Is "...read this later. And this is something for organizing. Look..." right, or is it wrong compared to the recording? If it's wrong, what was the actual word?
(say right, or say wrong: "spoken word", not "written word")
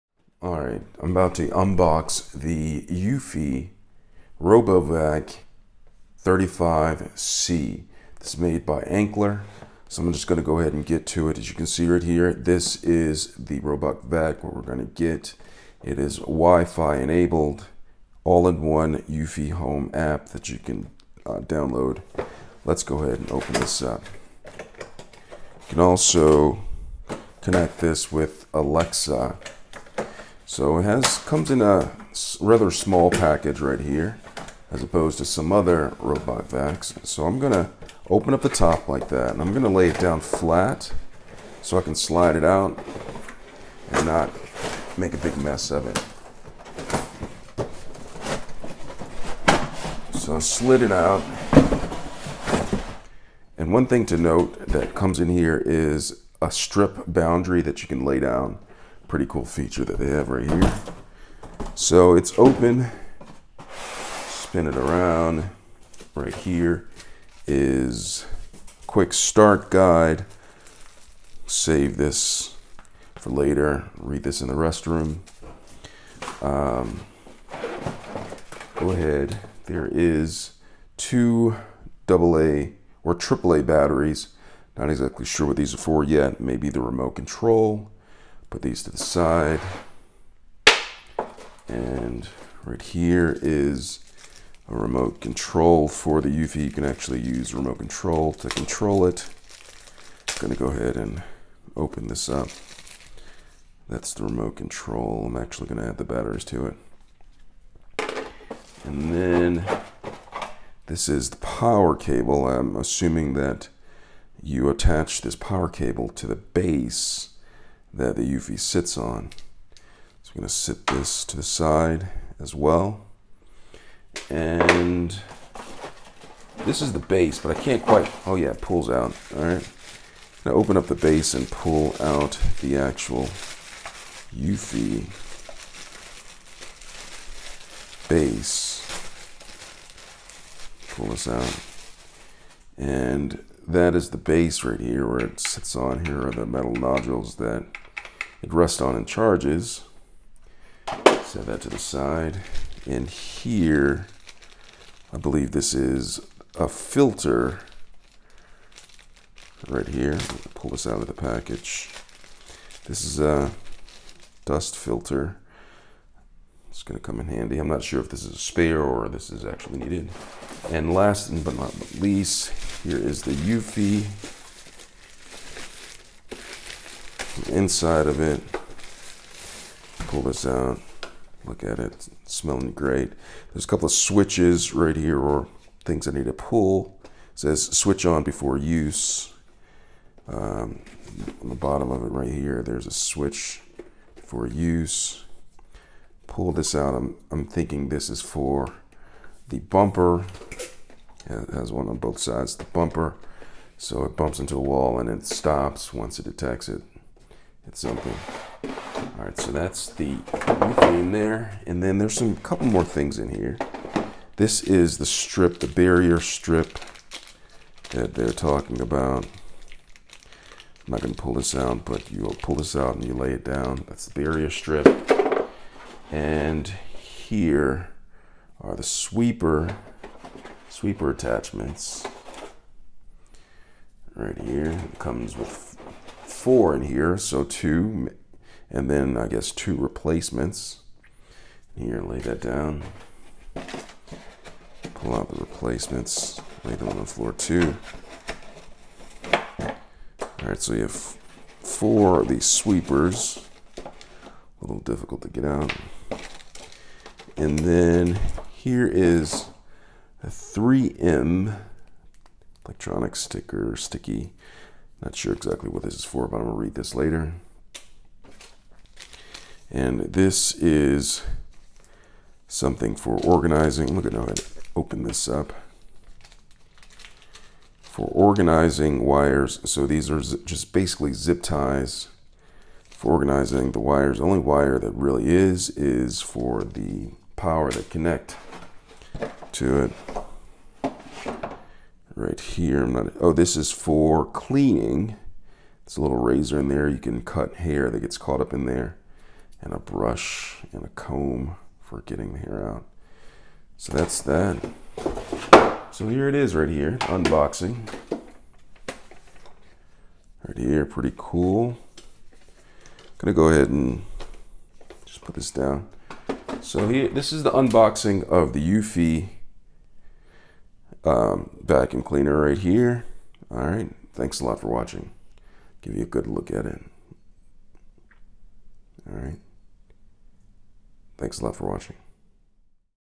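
right.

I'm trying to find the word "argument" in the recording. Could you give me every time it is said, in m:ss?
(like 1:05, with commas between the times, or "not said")
not said.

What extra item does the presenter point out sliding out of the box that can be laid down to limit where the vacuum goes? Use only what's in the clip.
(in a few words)
strip boundary.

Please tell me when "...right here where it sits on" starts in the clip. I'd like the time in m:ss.
2:24.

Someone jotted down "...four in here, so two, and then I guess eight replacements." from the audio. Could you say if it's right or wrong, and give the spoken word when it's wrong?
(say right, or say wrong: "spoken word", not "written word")
wrong: "two", not "eight".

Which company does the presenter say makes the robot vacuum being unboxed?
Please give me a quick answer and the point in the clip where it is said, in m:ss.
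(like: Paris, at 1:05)
Anker, at 0:08.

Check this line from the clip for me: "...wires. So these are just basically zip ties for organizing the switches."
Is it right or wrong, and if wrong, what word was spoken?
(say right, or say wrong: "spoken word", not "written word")
wrong: "wires", not "switches".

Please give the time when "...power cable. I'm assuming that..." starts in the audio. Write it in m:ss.
1:51.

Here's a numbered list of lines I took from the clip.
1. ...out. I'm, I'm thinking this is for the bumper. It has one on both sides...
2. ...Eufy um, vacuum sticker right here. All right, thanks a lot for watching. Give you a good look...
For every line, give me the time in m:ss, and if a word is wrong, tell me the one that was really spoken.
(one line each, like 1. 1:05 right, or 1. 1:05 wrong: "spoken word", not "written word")
1. 3:16 right
2. 5:18 wrong: "cleaner", not "sticker".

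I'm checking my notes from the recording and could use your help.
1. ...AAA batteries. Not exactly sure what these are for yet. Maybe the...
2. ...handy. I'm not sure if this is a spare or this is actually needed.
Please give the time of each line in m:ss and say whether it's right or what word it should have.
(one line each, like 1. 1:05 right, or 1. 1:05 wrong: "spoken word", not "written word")
1. 1:23 right
2. 2:47 right.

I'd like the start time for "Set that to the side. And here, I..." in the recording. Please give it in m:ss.
2:31.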